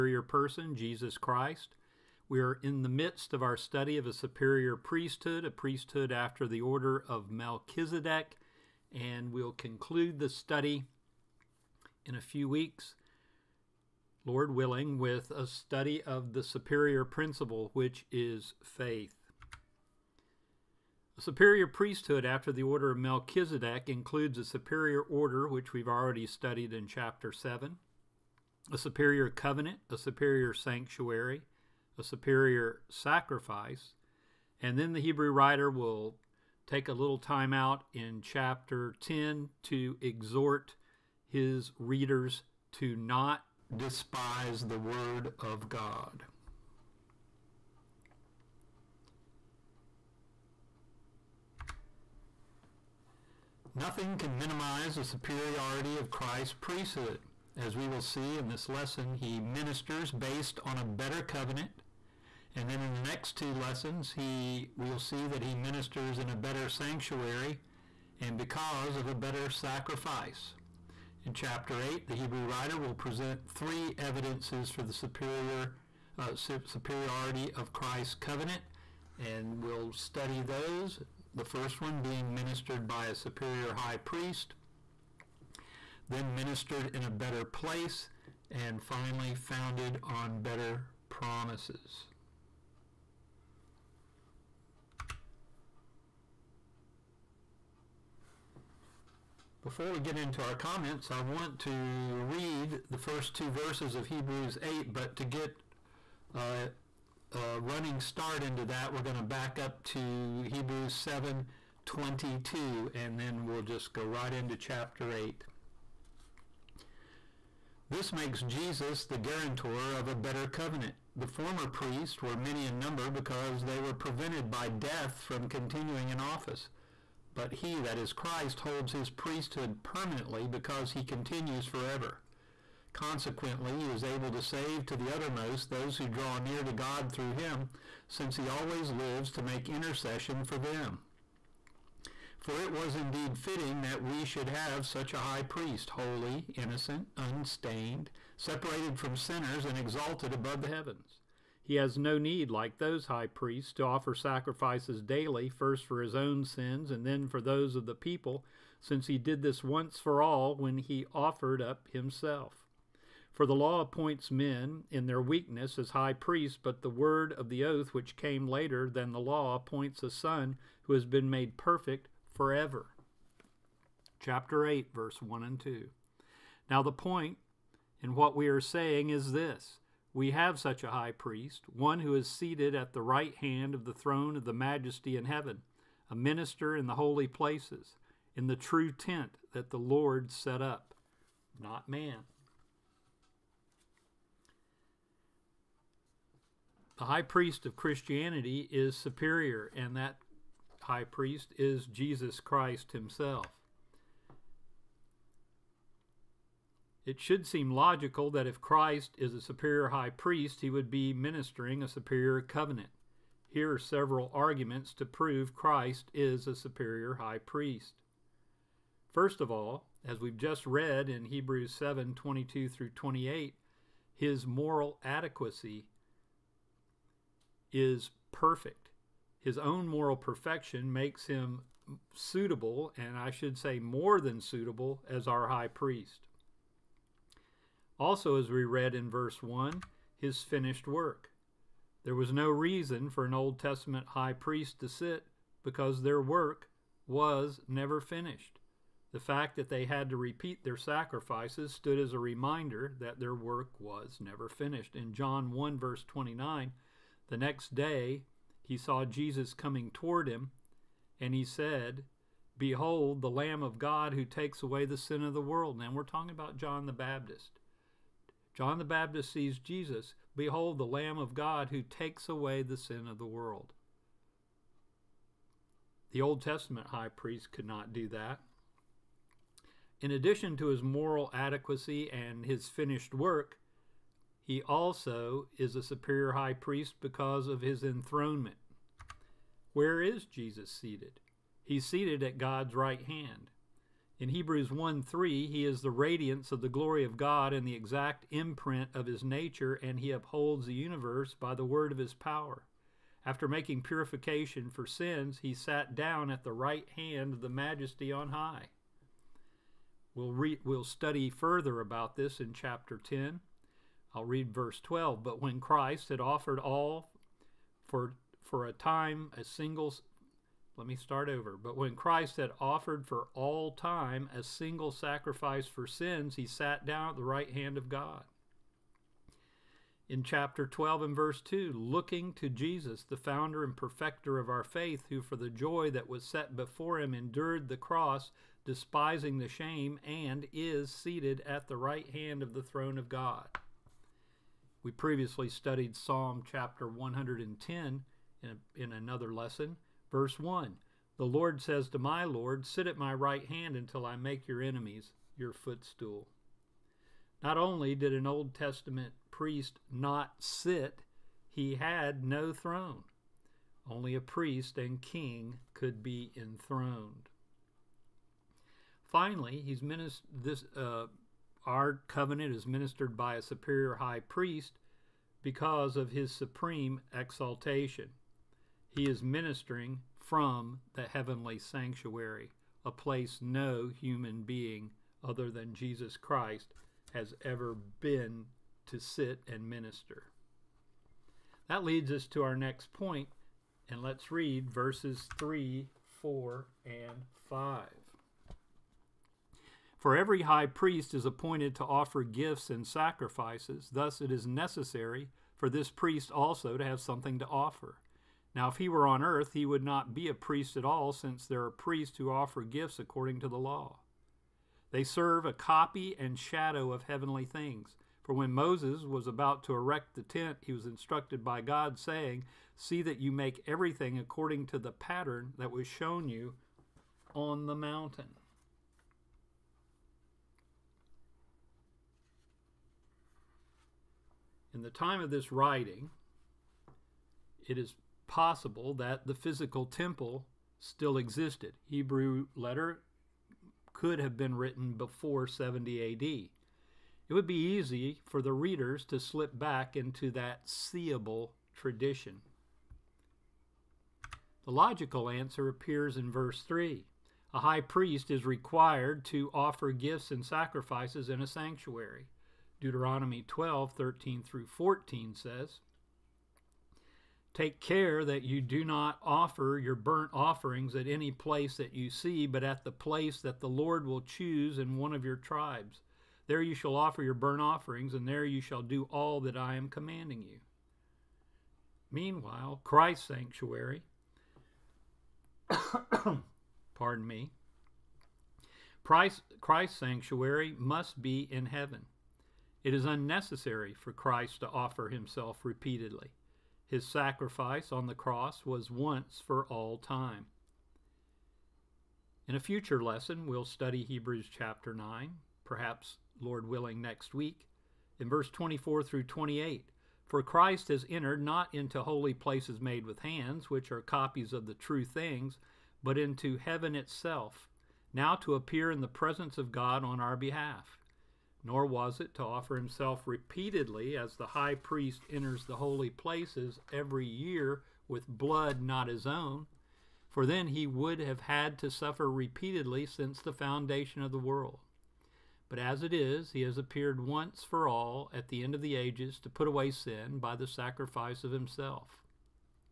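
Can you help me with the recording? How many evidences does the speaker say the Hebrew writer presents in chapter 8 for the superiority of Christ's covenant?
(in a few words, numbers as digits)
3.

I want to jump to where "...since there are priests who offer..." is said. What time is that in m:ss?
6:51.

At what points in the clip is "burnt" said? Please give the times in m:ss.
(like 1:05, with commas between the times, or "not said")
7:49, 7:57.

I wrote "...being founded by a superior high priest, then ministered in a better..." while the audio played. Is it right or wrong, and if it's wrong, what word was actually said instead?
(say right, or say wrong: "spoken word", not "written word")
wrong: "ministered", not "founded".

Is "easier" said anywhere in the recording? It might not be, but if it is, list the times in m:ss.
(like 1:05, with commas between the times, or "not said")
not said.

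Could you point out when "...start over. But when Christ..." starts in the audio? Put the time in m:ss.
5:20.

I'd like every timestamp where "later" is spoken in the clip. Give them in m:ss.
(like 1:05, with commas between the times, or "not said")
2:48.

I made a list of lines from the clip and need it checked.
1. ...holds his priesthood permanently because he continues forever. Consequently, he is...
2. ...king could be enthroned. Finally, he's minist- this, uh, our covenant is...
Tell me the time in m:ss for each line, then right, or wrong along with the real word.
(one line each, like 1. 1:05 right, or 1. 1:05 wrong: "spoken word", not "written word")
1. 2:08 right
2. 6:05 right.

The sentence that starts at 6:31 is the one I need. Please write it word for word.
That leads us to our next point, and let's read verses 3, 4, and 5.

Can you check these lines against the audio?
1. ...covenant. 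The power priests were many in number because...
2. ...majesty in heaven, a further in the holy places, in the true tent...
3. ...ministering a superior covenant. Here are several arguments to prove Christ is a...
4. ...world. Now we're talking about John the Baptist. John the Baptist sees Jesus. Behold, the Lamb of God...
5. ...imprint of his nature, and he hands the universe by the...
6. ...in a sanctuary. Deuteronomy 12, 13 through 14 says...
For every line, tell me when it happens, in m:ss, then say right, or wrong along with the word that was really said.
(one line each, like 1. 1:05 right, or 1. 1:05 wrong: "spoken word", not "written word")
1. 2:00 wrong: "former", not "power"
2. 3:04 wrong: "minister", not "further"
3. 3:31 right
4. 4:25 right
5. 4:58 wrong: "upholds", not "hands"
6. 7:41 right.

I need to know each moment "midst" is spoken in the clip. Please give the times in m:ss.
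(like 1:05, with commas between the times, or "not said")
0:02.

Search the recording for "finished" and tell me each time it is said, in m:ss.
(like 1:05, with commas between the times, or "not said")
4:00, 4:07, 4:14, 4:42.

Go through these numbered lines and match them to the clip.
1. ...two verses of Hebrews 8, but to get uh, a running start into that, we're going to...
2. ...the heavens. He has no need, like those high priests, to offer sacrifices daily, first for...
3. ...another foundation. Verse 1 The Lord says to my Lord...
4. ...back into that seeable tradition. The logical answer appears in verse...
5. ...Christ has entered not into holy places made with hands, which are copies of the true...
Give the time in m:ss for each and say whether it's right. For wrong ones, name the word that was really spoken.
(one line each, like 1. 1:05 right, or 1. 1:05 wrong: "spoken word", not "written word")
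1. 1:43 right
2. 2:30 right
3. 5:48 wrong: "lesson", not "foundation"
4. 7:29 right
5. 8:30 right.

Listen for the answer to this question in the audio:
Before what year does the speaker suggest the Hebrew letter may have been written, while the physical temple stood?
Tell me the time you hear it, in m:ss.
7:25.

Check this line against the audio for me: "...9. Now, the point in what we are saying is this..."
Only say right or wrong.
wrong.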